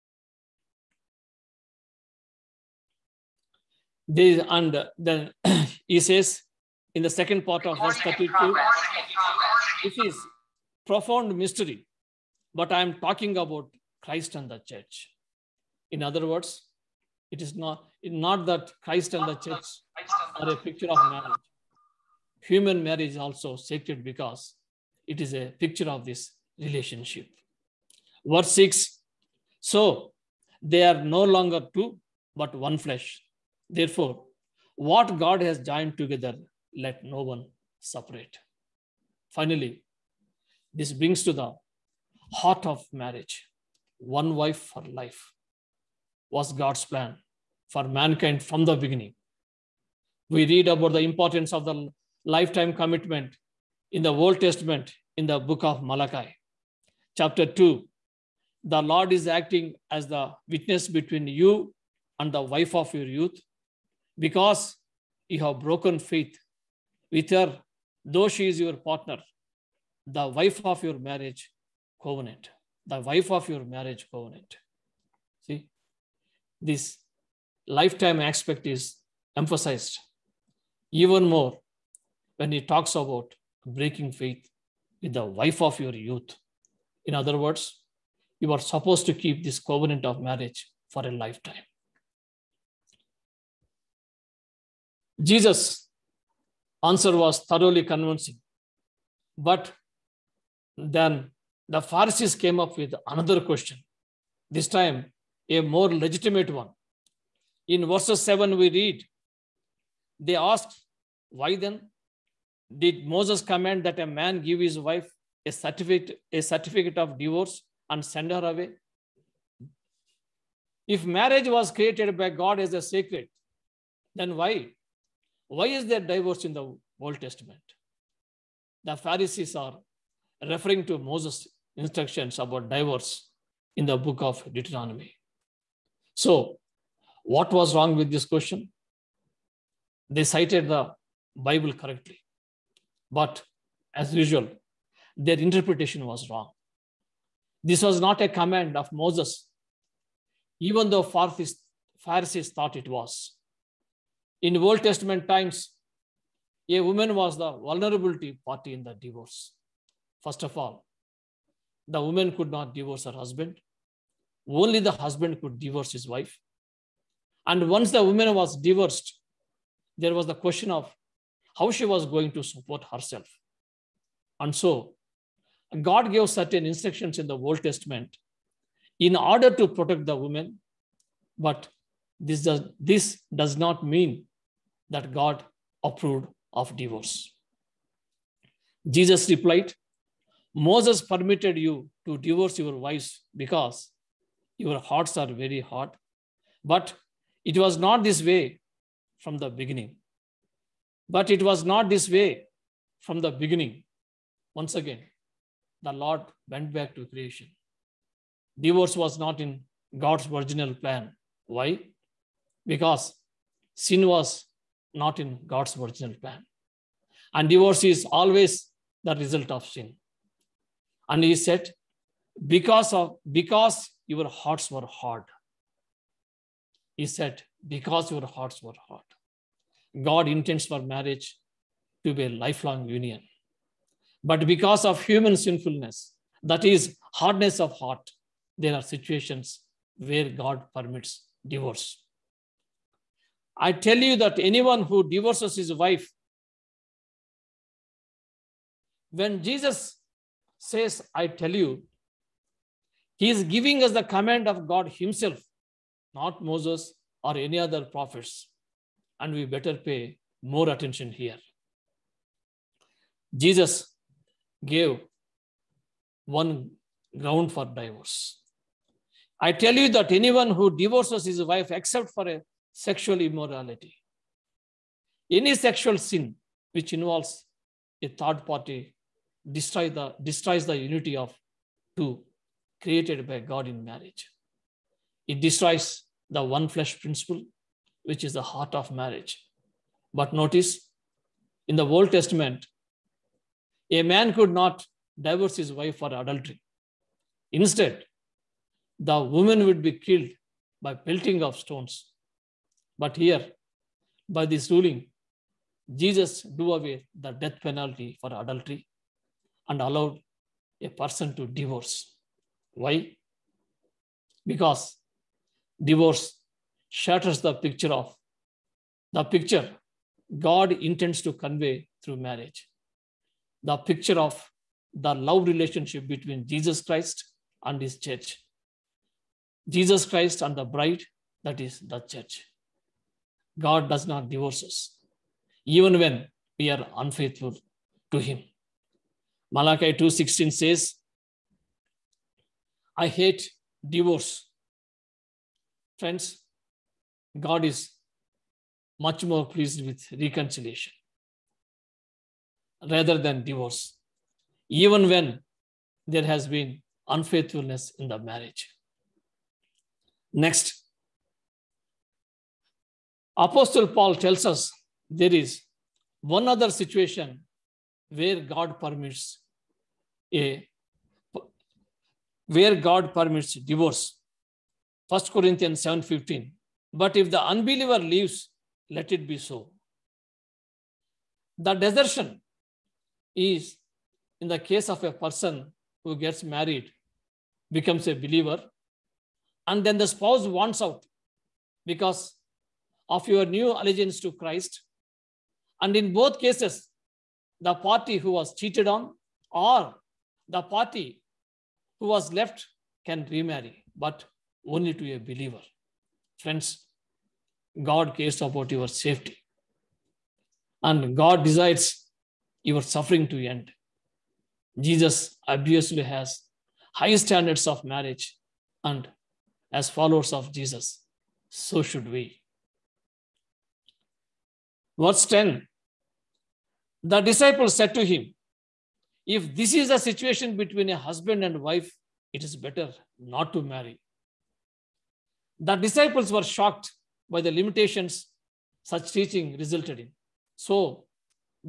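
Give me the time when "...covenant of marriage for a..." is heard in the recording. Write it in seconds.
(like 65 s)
89 s.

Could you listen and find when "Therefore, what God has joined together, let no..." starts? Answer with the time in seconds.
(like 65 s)
33 s.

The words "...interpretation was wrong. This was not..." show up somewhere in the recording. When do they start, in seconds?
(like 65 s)
145 s.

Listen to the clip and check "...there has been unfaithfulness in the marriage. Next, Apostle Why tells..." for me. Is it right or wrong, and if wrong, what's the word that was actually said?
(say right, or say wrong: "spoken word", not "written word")
wrong: "Paul", not "Why".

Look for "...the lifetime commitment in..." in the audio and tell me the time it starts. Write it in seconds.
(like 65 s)
51 s.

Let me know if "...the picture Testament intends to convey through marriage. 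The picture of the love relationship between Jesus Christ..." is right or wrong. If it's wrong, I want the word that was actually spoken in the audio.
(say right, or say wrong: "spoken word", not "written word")
wrong: "God", not "Testament".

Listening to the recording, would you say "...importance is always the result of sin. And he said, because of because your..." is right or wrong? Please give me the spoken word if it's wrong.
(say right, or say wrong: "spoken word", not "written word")
wrong: "divorce", not "importance".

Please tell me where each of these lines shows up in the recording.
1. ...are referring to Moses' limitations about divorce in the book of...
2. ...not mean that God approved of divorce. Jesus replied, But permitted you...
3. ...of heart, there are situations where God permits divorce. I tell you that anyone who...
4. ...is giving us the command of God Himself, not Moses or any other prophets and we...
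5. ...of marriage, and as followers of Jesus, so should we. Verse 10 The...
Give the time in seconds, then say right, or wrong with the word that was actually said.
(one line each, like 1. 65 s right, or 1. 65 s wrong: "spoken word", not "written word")
1. 129 s wrong: "instructions", not "limitations"
2. 183 s wrong: "Moses", not "But"
3. 237 s right
4. 253 s right
5. 417 s right.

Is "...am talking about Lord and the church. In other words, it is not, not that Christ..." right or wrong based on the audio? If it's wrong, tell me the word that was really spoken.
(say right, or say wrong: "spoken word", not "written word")
wrong: "Christ", not "Lord".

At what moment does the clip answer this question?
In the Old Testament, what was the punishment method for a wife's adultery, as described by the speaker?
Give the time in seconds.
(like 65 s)
301 s.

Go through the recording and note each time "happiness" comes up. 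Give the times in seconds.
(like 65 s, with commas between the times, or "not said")
not said.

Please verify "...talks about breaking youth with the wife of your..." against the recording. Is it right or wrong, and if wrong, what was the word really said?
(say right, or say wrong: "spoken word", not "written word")
wrong: "faith", not "youth".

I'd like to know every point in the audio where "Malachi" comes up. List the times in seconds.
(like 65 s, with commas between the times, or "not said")
55 s, 339 s.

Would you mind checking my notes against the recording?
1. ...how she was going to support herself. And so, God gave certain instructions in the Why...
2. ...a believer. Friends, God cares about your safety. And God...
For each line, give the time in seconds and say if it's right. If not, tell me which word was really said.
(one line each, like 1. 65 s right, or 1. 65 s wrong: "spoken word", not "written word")
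1. 171 s wrong: "Old", not "Why"
2. 405 s right.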